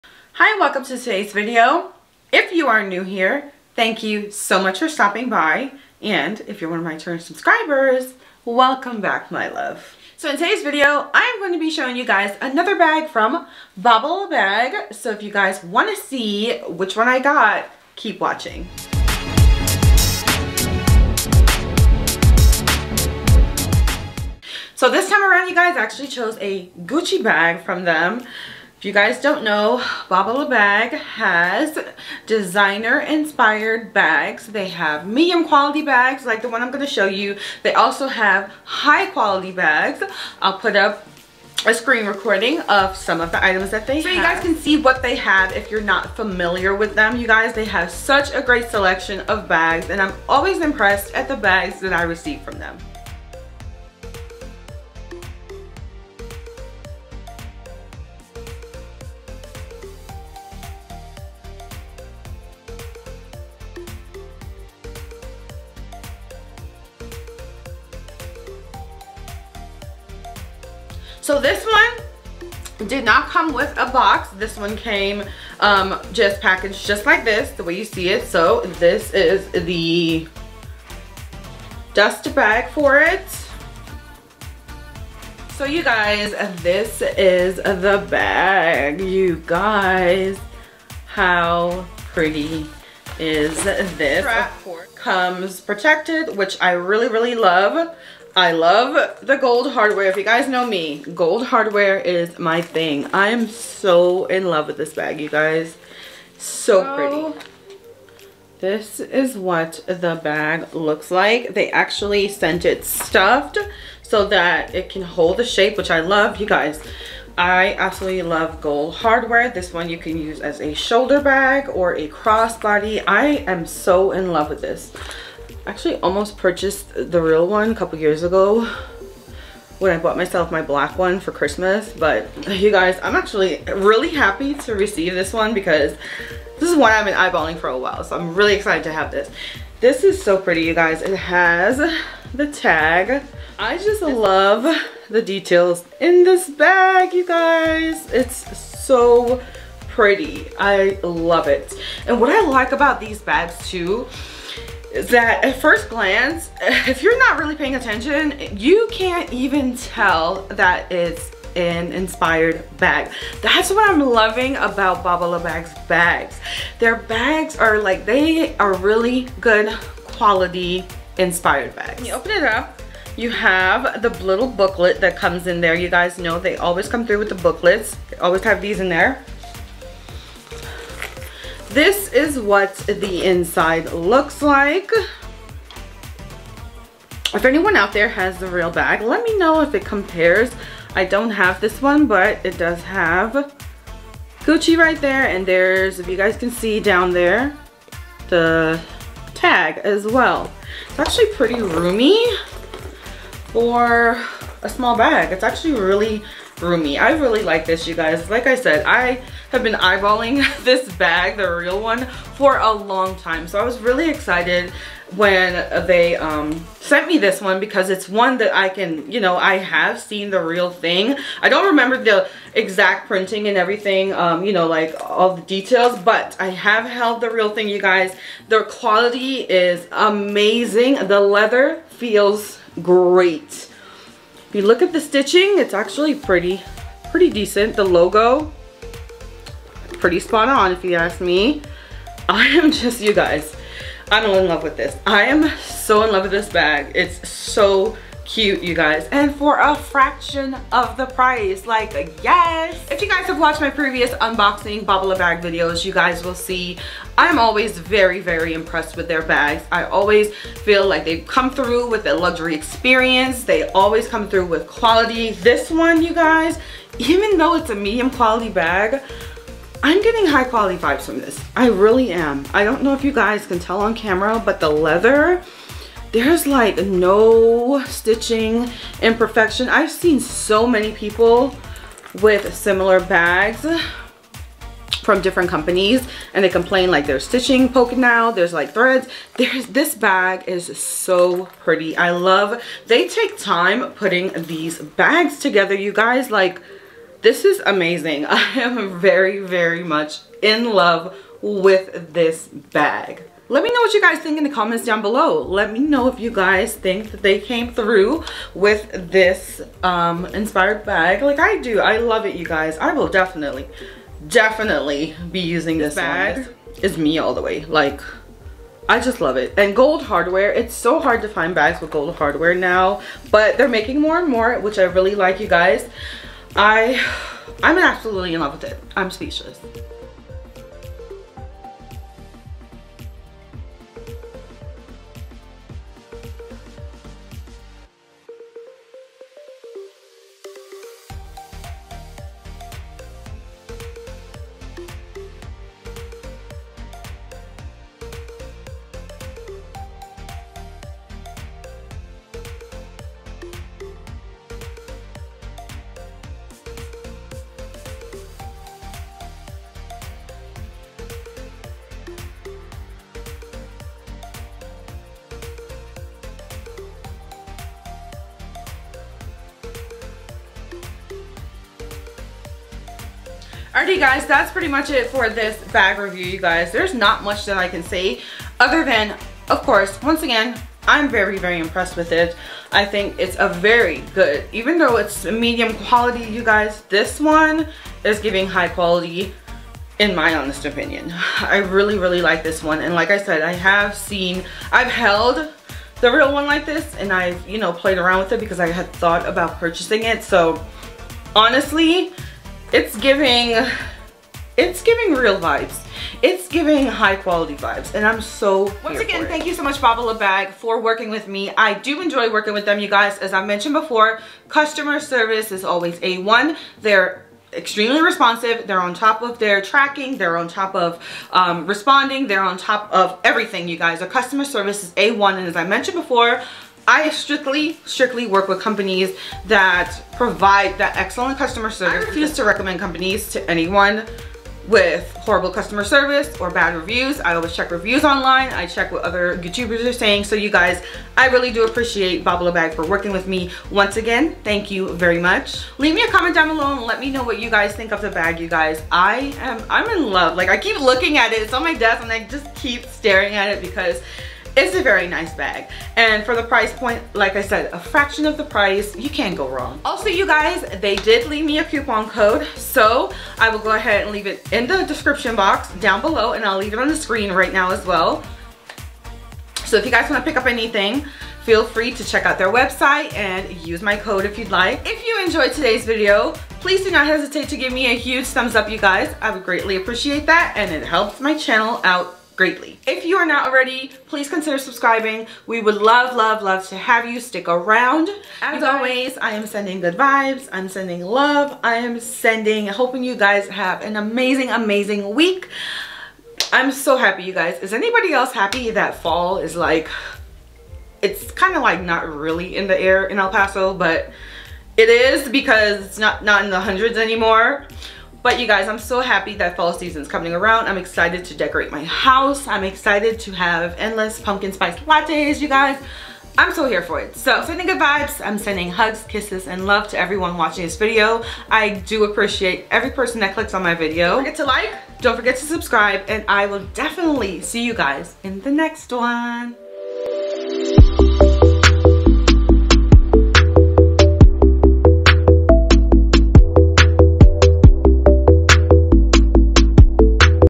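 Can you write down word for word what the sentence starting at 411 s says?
I do enjoy working with them, you guys.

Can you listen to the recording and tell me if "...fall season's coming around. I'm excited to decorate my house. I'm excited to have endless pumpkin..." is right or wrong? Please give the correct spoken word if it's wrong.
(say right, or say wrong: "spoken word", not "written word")
right.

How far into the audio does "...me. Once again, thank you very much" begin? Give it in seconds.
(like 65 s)
443 s.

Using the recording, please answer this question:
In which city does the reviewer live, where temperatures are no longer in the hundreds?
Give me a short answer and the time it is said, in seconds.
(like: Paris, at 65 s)
El Paso, at 503 s.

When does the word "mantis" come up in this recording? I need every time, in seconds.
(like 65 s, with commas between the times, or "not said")
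not said.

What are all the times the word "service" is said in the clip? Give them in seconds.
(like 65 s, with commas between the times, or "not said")
414 s, 424 s, 431 s, 435 s.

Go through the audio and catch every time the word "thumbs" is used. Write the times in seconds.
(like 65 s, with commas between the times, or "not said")
478 s.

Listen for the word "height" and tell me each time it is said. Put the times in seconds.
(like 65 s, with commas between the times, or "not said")
not said.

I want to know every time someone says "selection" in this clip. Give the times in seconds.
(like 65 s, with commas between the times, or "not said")
48 s.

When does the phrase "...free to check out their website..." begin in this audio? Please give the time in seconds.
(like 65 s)
471 s.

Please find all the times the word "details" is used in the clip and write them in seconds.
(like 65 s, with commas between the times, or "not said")
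145 s, 225 s.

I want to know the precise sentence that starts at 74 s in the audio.
This one came um, just packaged just like this, the way you see it.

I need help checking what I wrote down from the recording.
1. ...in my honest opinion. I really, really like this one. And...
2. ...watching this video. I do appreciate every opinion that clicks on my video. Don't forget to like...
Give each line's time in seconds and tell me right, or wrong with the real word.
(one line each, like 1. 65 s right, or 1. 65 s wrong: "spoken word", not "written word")
1. 389 s right
2. 520 s wrong: "person", not "opinion".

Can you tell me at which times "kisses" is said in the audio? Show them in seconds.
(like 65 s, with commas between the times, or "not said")
519 s.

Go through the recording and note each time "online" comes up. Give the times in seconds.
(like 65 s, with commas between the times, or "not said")
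438 s.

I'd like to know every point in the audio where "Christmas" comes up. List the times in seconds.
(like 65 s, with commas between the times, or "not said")
131 s.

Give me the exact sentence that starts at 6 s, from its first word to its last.
And if you're one of my current subscribers, welcome back, my love.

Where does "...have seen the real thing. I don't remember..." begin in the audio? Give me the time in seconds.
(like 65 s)
219 s.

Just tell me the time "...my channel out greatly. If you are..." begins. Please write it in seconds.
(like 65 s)
481 s.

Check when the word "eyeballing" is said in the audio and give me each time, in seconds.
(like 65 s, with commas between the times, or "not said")
137 s, 209 s.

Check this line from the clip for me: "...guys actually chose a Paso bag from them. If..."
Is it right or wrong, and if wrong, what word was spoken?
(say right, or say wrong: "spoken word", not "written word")
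wrong: "Gucci", not "Paso".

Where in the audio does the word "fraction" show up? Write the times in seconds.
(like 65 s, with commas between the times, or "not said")
249 s, 457 s.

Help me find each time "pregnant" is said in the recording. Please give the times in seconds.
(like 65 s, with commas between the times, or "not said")
not said.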